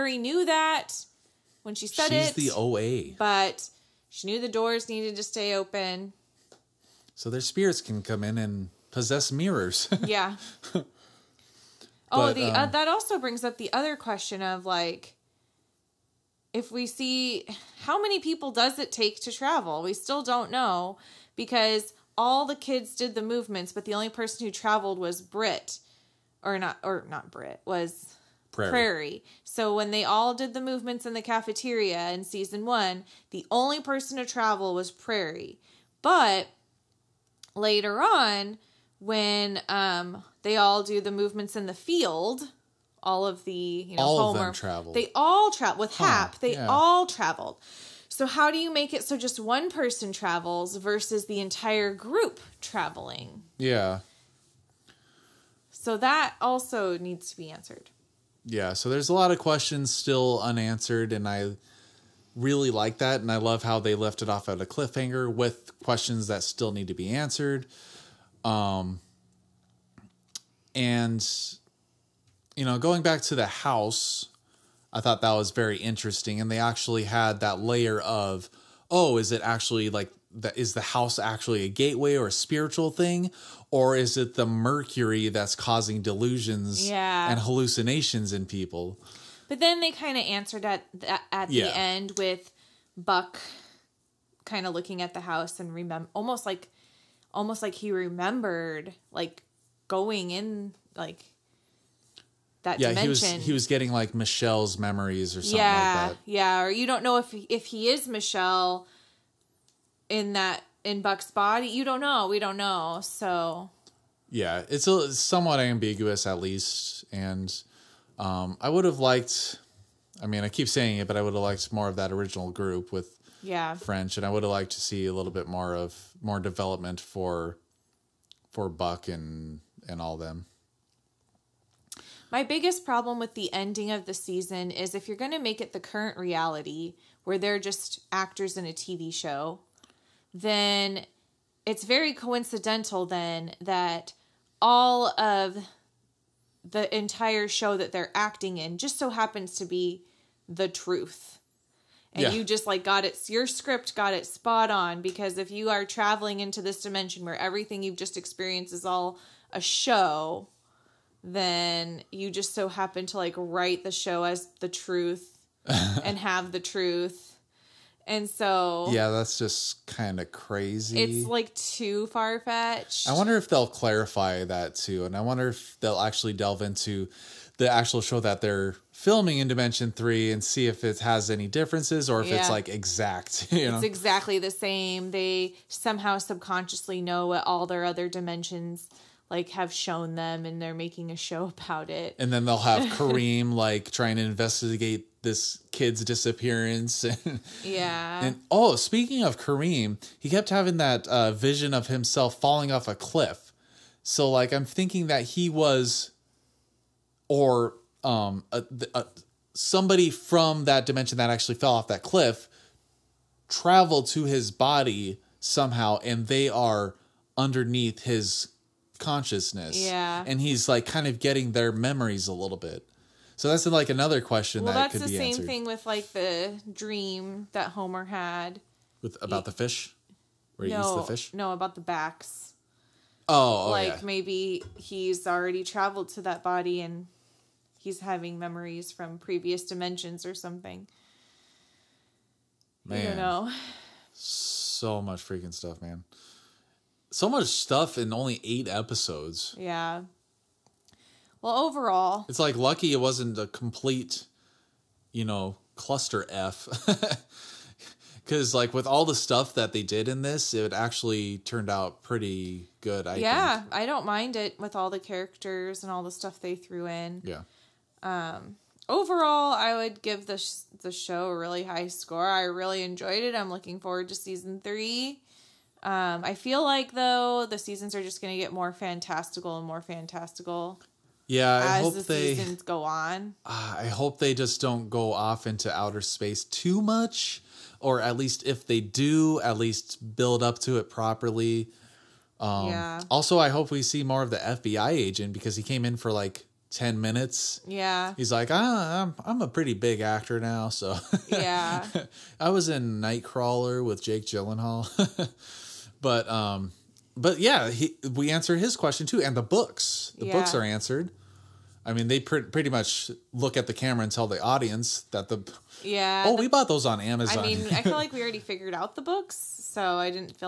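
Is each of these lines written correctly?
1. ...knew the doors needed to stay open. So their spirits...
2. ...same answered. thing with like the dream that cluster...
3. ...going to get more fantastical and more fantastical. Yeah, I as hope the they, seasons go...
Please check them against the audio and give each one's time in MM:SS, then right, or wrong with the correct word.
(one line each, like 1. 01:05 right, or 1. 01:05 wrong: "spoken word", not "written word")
1. 00:04 right
2. 03:45 wrong: "homer", not "cluster"
3. 04:38 right.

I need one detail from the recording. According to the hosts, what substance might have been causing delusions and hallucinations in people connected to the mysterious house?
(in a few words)
Mercury.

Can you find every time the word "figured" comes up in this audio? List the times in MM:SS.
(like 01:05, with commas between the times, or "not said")
05:18.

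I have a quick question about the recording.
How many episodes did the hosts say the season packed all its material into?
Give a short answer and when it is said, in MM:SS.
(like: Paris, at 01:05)
8, at 04:08.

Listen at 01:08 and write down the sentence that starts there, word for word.
Um, and, you know, going back to the house, I thought that was very interesting.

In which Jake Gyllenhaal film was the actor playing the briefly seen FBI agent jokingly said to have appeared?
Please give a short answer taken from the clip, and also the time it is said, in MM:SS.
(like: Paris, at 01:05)
Nightcrawler, at 05:03.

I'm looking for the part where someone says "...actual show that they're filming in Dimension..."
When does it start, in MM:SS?
02:57.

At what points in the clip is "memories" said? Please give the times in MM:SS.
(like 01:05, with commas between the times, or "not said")
01:44, 03:41, 03:58.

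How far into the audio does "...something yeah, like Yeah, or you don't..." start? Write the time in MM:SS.
01:45.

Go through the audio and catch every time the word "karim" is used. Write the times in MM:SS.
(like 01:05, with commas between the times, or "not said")
03:12, 03:19.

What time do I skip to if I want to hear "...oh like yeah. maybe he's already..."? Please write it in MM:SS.
03:53.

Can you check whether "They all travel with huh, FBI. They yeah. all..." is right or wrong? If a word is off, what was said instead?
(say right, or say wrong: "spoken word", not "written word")
wrong: "Hap", not "FBI".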